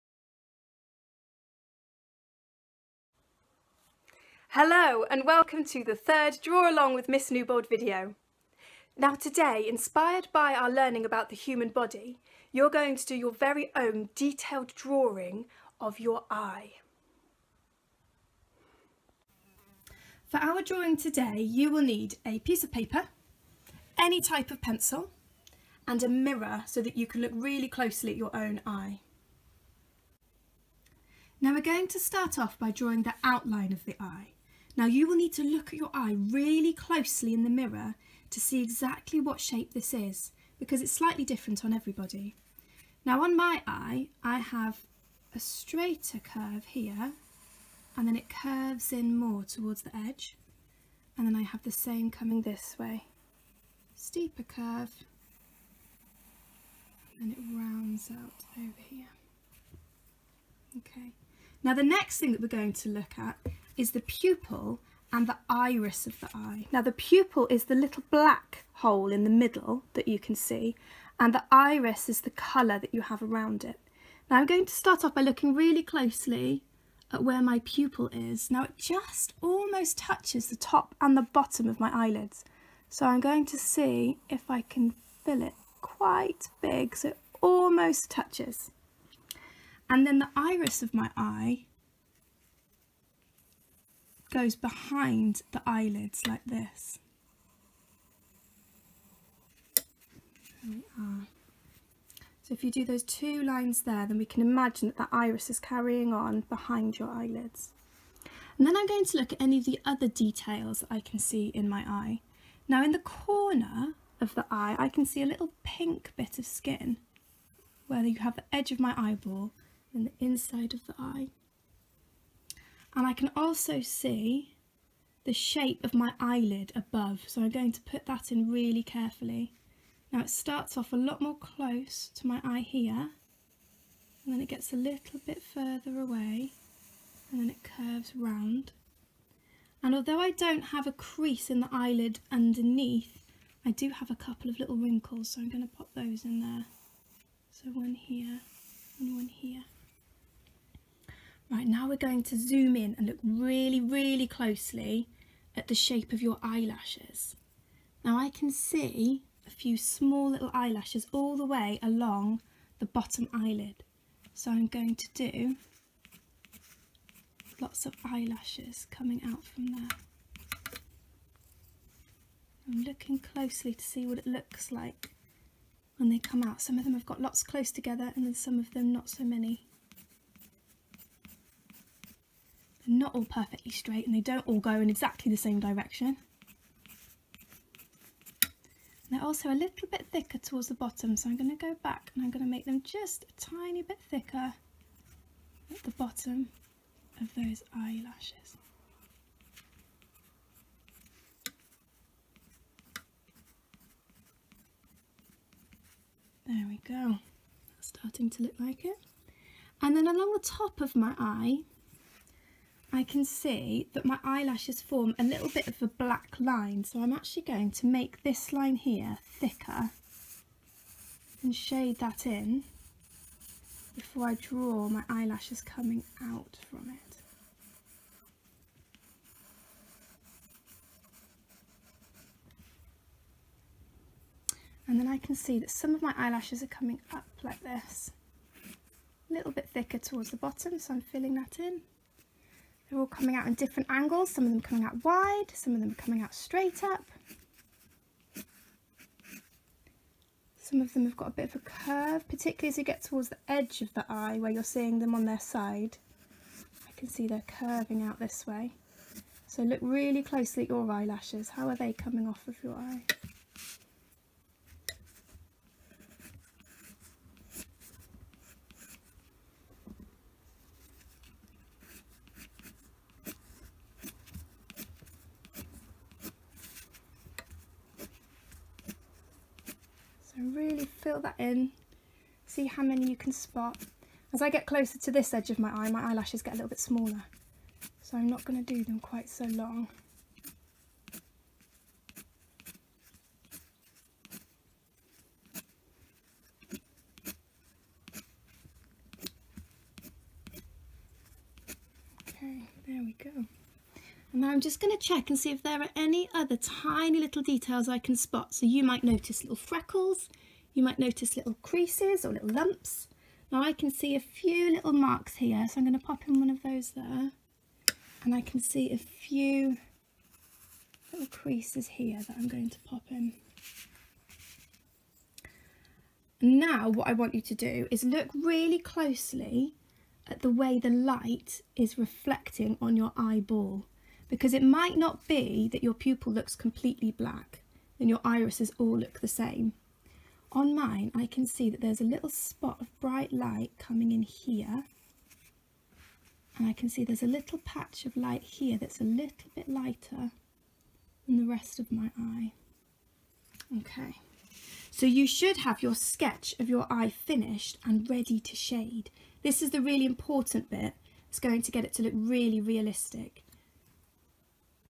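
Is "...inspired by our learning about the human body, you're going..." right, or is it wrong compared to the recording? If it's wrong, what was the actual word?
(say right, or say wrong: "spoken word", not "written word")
right.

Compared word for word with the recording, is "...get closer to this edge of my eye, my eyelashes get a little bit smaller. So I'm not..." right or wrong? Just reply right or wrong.
right.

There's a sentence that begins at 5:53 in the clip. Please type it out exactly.
Okay, so you should have your sketch of your eye finished and ready to shade.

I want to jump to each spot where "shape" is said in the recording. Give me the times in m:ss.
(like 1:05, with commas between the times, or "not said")
0:39, 2:05, 2:35.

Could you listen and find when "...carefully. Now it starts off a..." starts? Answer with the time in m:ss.
2:08.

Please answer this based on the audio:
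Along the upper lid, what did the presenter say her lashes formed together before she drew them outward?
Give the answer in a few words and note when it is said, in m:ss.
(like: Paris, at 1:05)
A black line, at 3:35.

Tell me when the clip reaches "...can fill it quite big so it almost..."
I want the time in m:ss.
1:24.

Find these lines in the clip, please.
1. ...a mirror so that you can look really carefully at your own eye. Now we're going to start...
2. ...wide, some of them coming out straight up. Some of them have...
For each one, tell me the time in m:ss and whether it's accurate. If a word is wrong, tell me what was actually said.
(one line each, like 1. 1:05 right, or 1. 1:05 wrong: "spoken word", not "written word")
1. 0:26 wrong: "closely", not "carefully"
2. 4:05 right.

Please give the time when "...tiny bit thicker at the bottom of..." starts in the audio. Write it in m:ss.
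3:13.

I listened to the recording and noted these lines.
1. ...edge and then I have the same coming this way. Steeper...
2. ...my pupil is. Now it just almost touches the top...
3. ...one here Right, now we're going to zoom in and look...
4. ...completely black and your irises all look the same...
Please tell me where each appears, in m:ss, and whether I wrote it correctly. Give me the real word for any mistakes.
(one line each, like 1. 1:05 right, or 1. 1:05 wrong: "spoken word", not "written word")
1. 0:49 right
2. 1:17 right
3. 2:27 right
4. 5:36 right.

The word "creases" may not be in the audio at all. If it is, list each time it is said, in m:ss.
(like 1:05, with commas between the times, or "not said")
2:20, 5:11, 5:21.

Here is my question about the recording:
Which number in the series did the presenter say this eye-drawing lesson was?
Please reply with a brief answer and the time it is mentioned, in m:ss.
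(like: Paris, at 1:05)
Third, at 0:05.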